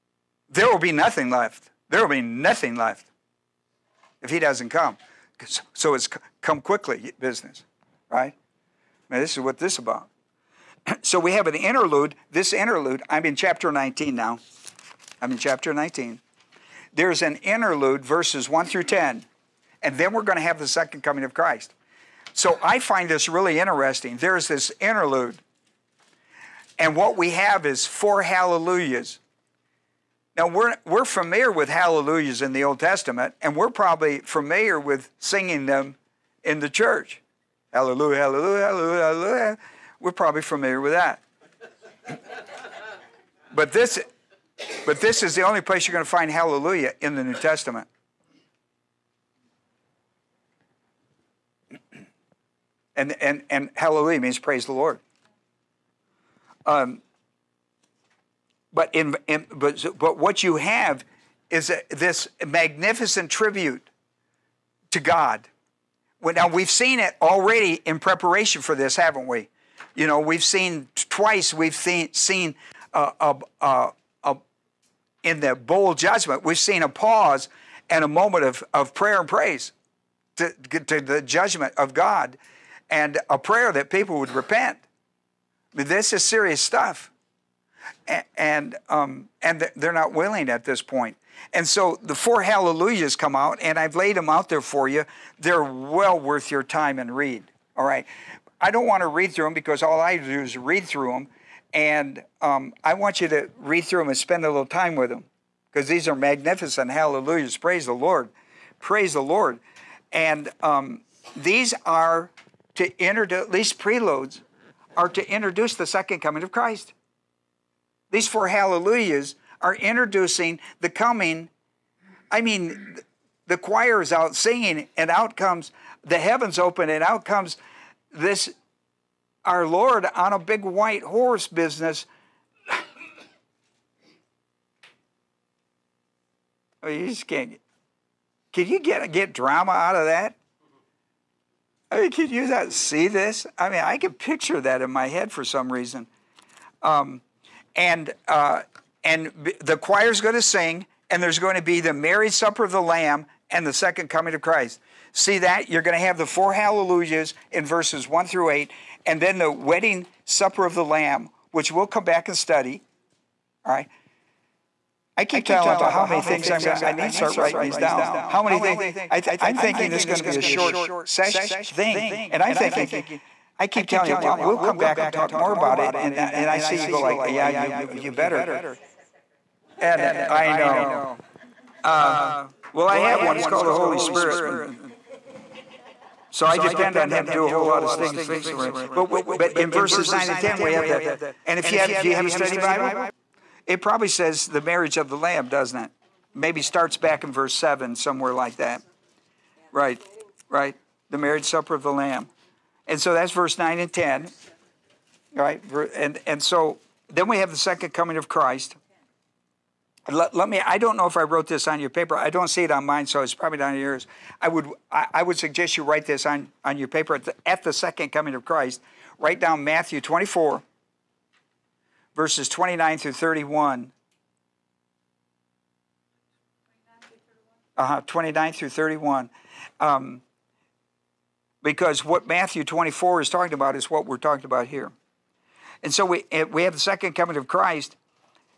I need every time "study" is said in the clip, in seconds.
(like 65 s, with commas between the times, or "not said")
162 s, 192 s.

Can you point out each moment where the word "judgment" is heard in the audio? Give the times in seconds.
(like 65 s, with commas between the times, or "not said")
75 s, 81 s.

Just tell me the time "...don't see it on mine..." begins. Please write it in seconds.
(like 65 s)
212 s.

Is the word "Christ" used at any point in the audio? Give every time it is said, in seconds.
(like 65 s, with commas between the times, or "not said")
21 s, 116 s, 154 s, 208 s, 218 s, 237 s.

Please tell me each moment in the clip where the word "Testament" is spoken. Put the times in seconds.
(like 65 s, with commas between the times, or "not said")
32 s, 47 s.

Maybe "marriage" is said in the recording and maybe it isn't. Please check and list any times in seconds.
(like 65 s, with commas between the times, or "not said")
151 s, 194 s, 201 s.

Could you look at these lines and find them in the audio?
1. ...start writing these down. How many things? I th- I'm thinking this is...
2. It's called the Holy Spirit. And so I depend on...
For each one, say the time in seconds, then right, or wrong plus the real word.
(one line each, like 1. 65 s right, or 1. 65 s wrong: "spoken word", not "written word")
1. 167 s right
2. 183 s right.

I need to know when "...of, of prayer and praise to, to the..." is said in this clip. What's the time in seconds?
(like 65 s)
78 s.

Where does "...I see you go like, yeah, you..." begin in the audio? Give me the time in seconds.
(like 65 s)
176 s.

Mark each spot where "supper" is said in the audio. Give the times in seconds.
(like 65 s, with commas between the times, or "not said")
152 s, 160 s, 201 s.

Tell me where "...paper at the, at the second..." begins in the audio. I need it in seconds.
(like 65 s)
216 s.